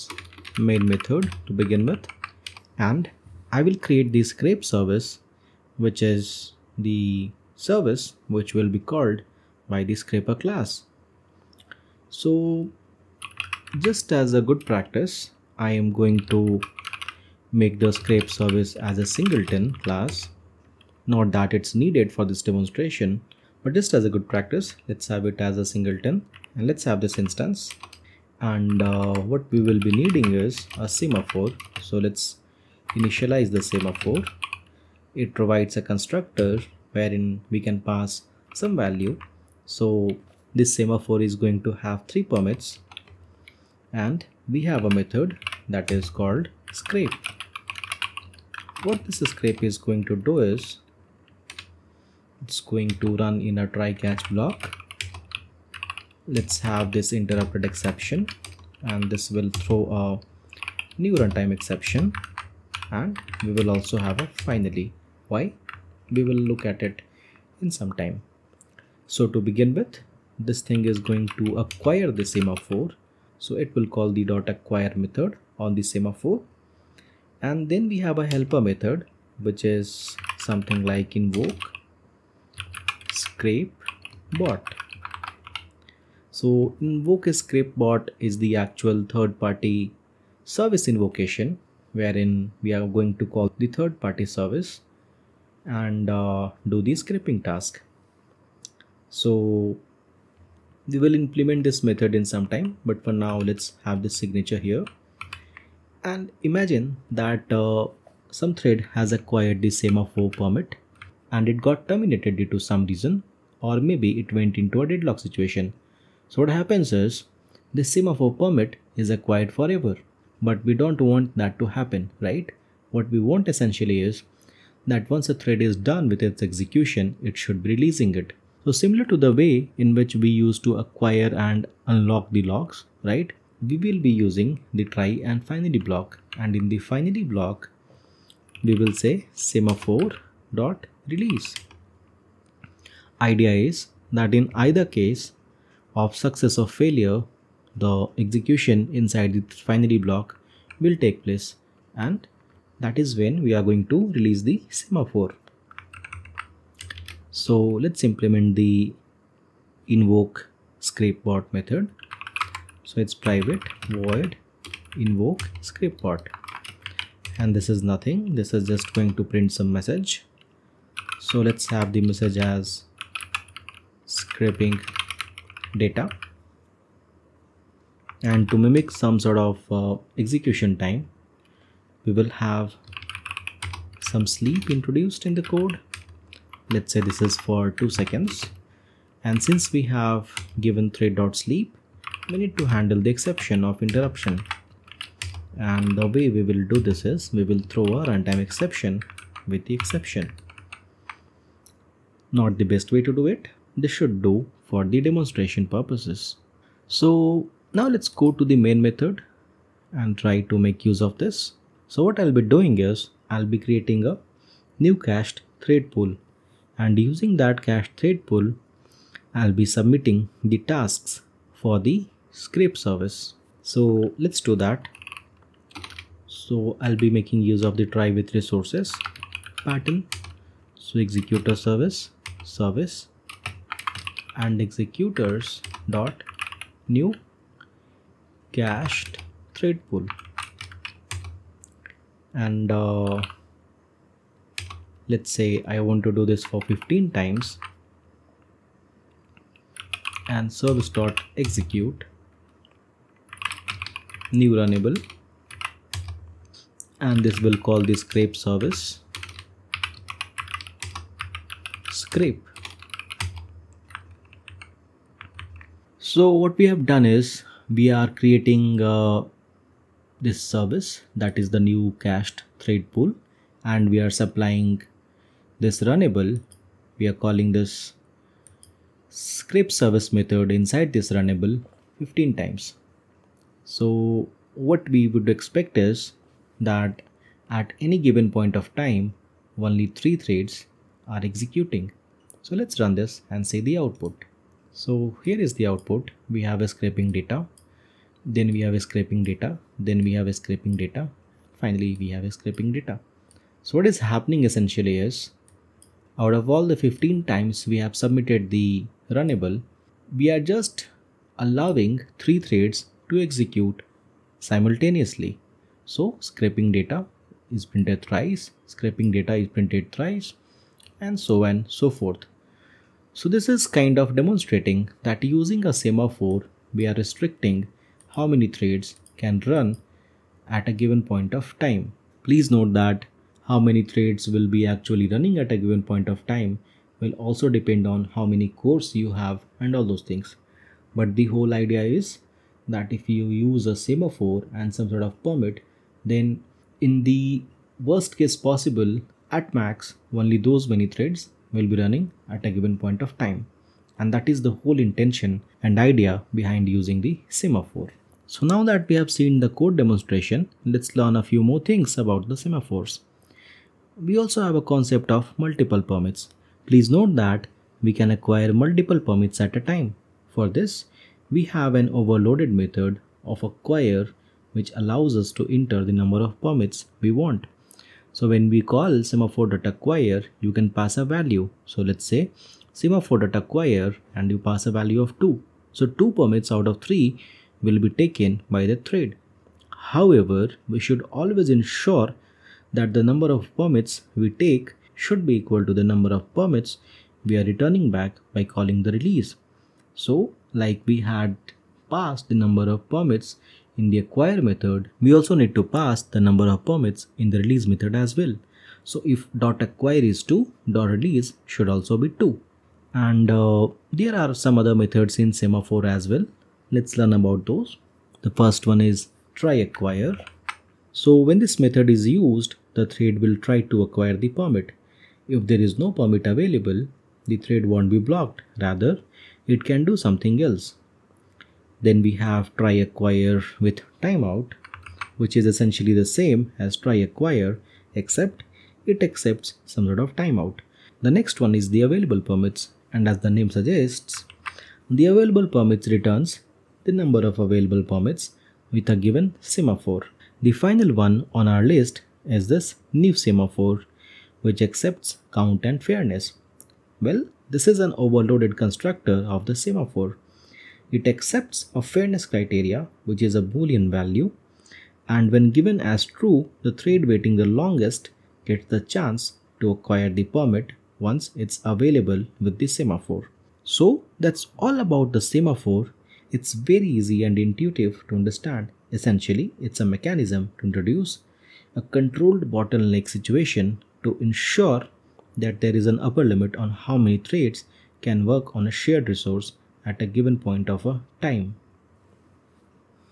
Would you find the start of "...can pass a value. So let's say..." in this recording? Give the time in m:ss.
6:20.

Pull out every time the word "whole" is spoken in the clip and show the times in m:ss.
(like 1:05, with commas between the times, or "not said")
5:41, 5:54.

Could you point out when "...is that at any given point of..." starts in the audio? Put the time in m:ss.
4:45.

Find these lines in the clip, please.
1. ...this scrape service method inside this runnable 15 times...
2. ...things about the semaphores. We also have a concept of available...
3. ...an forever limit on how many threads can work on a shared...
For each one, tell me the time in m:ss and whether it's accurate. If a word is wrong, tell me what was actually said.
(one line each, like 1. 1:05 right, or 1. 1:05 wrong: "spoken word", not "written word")
1. 4:37 right
2. 6:01 wrong: "multiple", not "available"
3. 8:05 wrong: "upper", not "forever".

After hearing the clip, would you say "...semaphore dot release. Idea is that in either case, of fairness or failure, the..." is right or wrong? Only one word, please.
wrong.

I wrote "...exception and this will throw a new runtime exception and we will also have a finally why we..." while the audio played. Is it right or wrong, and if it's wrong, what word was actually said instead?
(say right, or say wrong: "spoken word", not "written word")
right.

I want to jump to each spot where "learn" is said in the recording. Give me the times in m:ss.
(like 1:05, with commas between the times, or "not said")
6:00, 6:56.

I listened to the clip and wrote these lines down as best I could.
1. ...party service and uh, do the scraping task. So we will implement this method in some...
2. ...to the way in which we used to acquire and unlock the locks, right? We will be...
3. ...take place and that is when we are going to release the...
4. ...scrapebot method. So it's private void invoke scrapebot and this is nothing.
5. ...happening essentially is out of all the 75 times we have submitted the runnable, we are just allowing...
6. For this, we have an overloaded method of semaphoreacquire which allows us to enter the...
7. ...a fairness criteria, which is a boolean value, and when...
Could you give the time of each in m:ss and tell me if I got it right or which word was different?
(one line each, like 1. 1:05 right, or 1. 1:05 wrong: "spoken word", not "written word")
1. 1:34 right
2. 2:09 right
3. 2:30 right
4. 2:40 right
5. 5:03 wrong: "15", not "75"
6. 6:10 wrong: "acquire", not "semaphoreacquire"
7. 7:41 right.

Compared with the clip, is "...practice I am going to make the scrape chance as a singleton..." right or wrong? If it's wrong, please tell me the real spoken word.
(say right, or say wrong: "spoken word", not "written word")
wrong: "service", not "chance".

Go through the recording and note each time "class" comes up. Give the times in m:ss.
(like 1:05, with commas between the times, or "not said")
0:10, 0:19.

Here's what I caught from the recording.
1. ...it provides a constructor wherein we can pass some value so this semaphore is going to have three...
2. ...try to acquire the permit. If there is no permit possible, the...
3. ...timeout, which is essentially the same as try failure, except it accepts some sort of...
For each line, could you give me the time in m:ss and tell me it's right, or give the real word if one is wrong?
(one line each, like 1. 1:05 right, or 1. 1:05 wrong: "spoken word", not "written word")
1. 0:35 right
2. 7:03 wrong: "available", not "possible"
3. 7:14 wrong: "acquire", not "failure".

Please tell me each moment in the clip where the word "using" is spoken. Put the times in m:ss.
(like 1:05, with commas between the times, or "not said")
2:14, 3:36, 5:25, 5:56.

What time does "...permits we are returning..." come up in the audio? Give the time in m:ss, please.
6:36.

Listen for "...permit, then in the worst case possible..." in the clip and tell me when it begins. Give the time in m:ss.
5:45.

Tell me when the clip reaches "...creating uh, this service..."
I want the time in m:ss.
4:28.